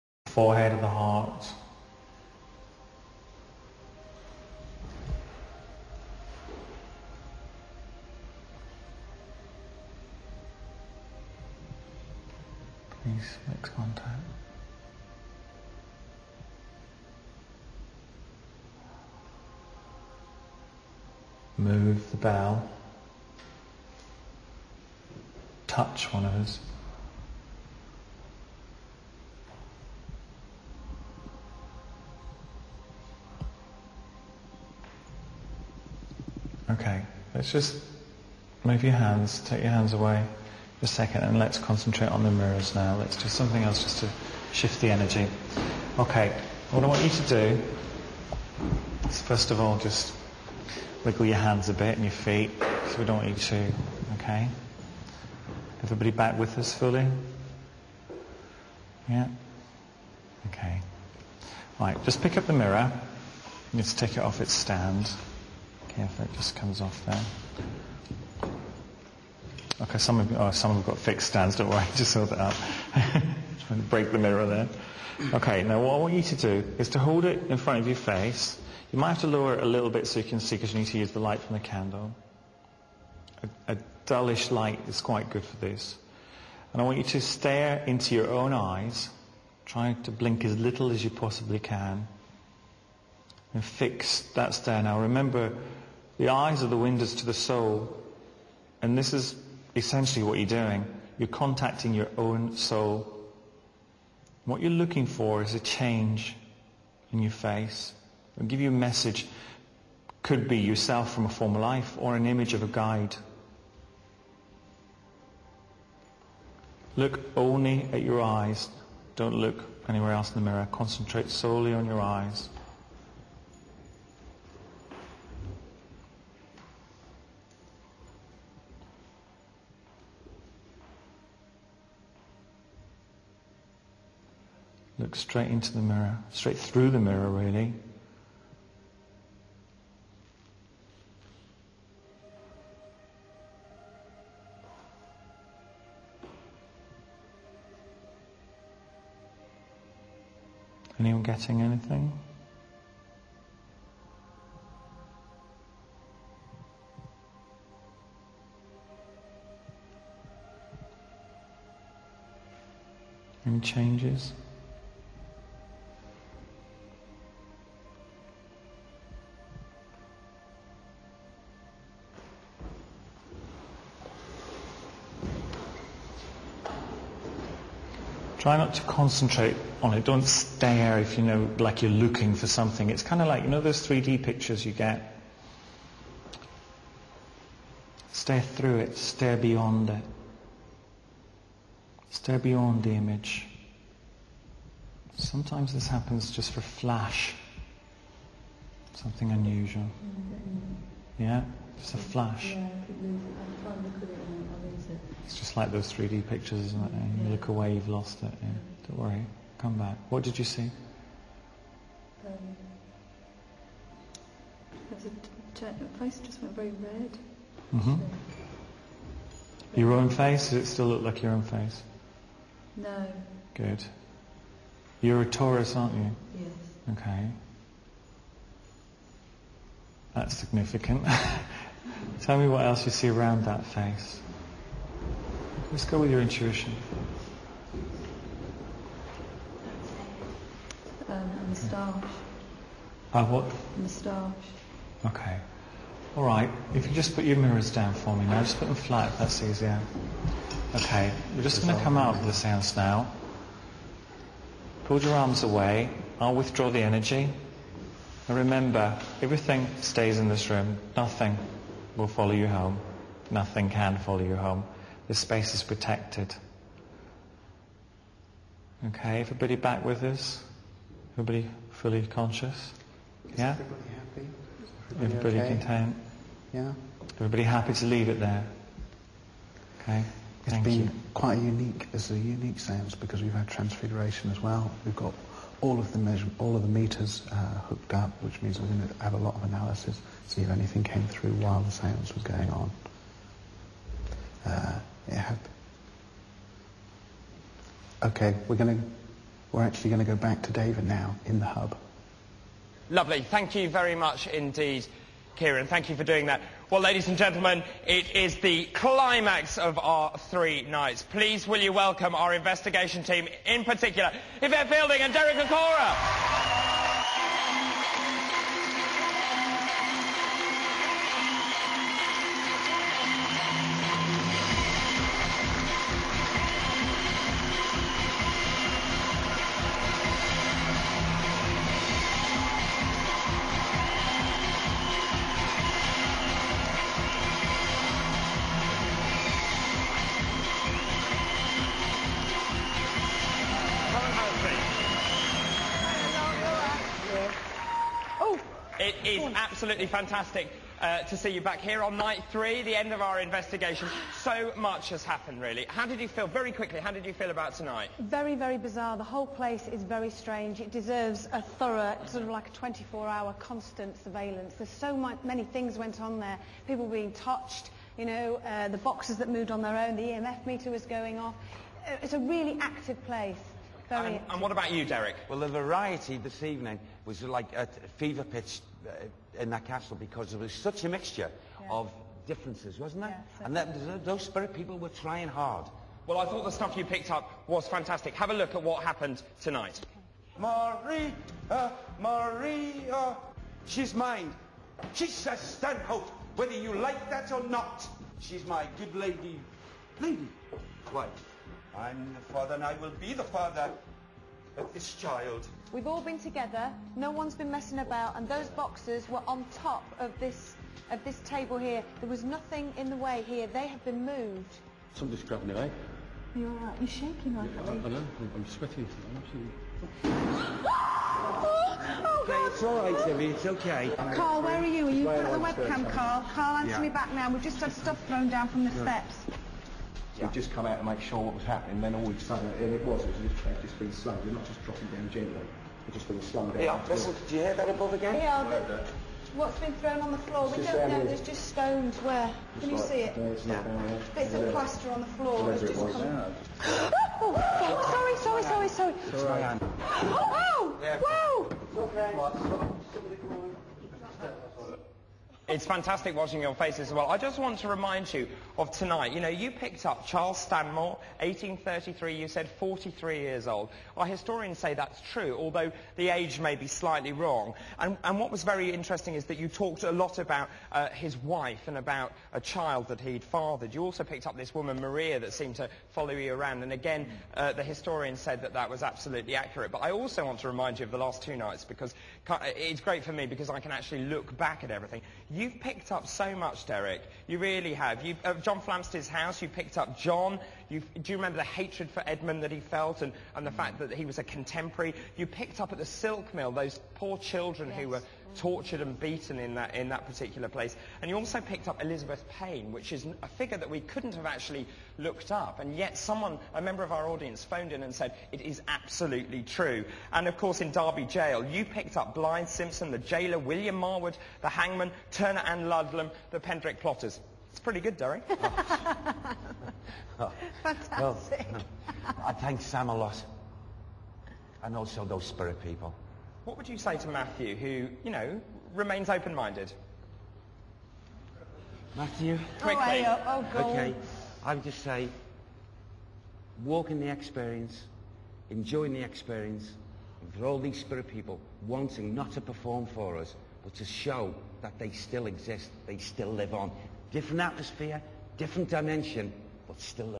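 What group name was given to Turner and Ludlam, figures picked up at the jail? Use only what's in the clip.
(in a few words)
Pentrich plotters.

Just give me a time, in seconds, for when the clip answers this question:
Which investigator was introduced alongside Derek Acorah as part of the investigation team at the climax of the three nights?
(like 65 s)
314 s.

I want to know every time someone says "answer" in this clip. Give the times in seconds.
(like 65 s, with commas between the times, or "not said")
426 s.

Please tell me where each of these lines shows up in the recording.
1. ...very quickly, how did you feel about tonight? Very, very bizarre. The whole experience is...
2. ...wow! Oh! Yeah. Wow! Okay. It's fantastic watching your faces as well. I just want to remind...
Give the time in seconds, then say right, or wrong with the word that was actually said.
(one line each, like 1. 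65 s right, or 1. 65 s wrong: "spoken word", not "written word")
1. 356 s wrong: "place", not "experience"
2. 450 s right.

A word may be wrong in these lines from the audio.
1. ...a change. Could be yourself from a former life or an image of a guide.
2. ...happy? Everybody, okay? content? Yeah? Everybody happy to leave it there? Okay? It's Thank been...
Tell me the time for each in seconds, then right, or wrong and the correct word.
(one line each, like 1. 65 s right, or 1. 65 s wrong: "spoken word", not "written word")
1. 108 s wrong: "message", not "change"
2. 273 s right.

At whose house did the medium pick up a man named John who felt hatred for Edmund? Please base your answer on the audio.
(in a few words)
John Flamsteed.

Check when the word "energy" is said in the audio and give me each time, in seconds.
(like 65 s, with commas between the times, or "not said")
44 s, 256 s.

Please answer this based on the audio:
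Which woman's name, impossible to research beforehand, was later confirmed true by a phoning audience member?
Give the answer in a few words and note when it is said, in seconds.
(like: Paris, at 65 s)
Elizabeth Payne, at 501 s.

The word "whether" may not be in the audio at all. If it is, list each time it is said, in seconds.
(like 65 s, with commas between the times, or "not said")
396 s.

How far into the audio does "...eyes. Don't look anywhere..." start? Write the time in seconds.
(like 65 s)
118 s.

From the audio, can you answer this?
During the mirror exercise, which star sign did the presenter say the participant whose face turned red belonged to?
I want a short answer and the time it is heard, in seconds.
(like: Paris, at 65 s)
Taurus, at 225 s.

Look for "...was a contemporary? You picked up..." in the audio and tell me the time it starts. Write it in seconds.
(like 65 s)
494 s.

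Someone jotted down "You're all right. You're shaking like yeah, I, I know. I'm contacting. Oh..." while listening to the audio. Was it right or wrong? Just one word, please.
wrong.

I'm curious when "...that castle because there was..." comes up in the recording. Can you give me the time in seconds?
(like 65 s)
379 s.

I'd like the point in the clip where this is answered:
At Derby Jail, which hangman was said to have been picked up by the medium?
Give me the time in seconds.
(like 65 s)
513 s.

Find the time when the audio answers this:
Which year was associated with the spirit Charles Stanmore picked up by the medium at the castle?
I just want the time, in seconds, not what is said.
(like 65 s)
461 s.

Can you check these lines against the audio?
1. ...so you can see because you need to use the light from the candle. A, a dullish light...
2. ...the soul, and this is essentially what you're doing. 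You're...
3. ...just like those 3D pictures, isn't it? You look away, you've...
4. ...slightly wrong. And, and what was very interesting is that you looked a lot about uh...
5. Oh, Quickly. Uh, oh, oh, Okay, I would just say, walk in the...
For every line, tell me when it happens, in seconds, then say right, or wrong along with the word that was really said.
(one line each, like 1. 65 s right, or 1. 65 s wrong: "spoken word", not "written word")
1. 80 s right
2. 97 s right
3. 205 s right
4. 466 s wrong: "talked", not "looked"
5. 532 s right.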